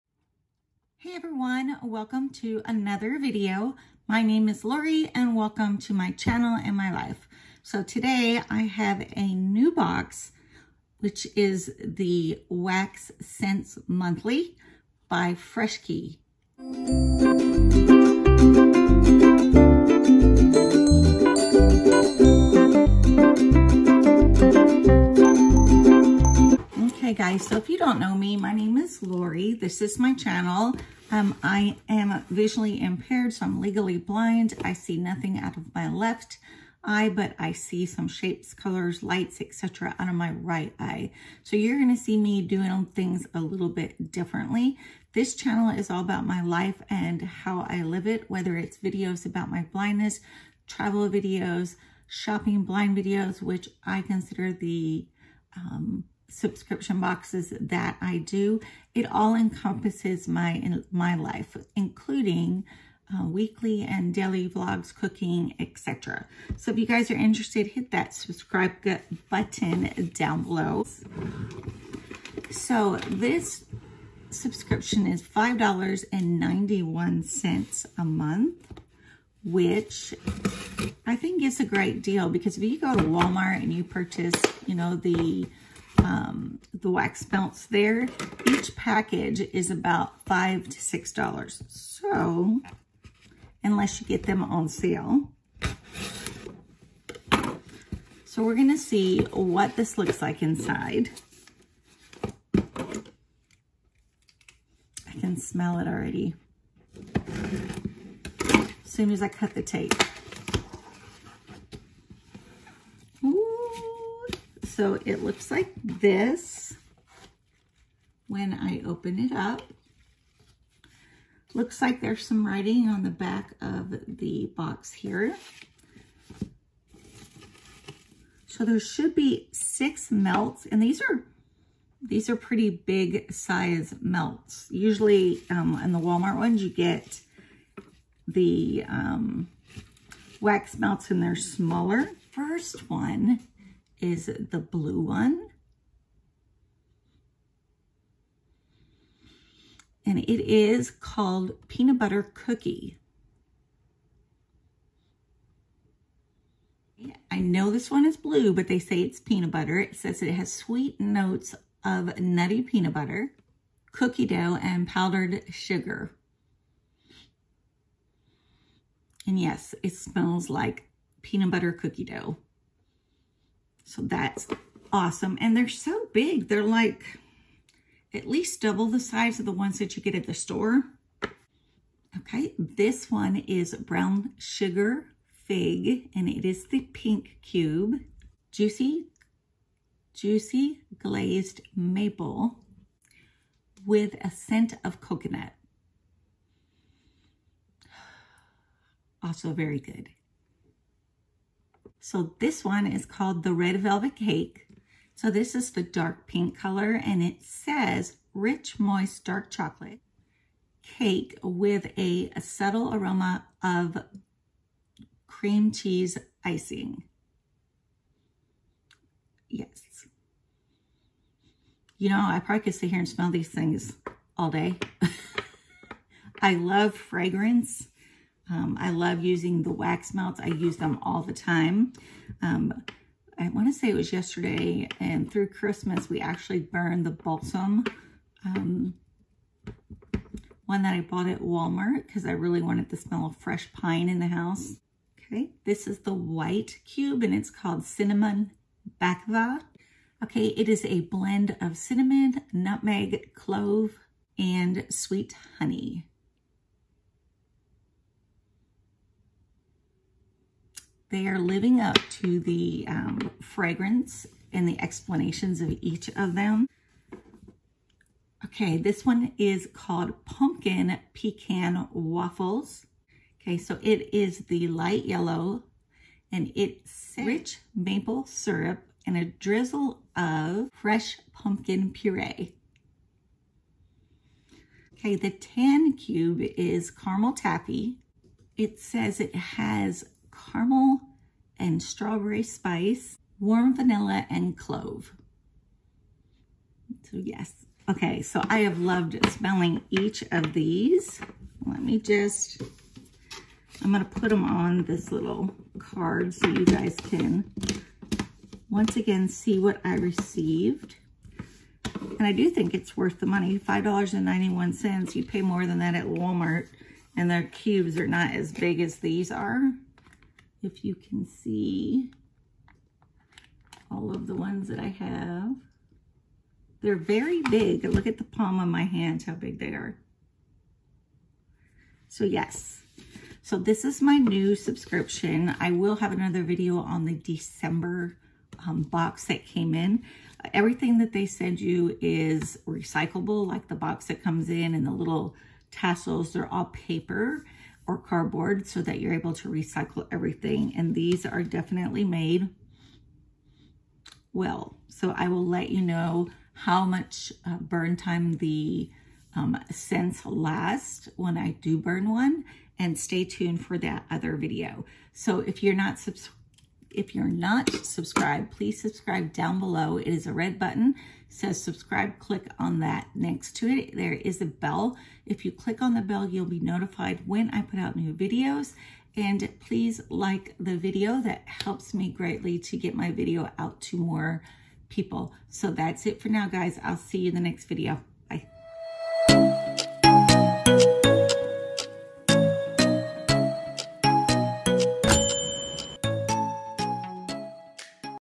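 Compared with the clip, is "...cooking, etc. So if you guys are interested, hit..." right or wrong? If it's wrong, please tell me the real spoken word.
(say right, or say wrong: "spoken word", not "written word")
right.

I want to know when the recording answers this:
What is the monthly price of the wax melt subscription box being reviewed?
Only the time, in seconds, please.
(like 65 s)
75 s.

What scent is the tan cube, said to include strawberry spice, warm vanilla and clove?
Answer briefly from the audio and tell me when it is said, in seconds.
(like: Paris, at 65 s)
Caramel taffy, at 286 s.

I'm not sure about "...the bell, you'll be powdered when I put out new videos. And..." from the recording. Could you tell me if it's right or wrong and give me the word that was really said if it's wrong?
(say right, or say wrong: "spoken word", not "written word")
wrong: "notified", not "powdered".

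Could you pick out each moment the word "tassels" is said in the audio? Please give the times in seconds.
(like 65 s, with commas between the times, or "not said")
345 s.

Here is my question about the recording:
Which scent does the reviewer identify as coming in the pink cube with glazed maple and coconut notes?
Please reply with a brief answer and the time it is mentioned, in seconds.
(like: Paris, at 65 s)
Brown sugar fig, at 183 s.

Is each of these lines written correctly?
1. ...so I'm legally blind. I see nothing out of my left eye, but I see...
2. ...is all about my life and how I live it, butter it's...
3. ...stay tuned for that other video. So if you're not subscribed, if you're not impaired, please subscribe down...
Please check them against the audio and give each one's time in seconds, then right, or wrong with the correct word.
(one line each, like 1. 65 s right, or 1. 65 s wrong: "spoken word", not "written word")
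1. 33 s right
2. 45 s wrong: "whether", not "butter"
3. 362 s wrong: "subscribed", not "impaired".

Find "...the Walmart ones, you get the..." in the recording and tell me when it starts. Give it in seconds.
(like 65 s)
135 s.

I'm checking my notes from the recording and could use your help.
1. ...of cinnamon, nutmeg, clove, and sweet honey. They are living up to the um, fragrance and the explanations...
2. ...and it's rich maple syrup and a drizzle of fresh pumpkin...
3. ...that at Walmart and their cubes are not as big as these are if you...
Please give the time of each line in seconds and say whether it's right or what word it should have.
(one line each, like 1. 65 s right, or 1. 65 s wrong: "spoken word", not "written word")
1. 251 s right
2. 276 s right
3. 315 s right.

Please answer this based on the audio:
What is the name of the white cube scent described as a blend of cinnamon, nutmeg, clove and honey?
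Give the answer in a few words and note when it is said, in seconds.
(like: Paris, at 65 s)
Cinnamon Bakva, at 247 s.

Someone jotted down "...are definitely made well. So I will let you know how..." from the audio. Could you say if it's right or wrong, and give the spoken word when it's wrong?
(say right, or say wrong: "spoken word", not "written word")
right.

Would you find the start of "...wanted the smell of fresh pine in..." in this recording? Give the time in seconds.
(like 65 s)
242 s.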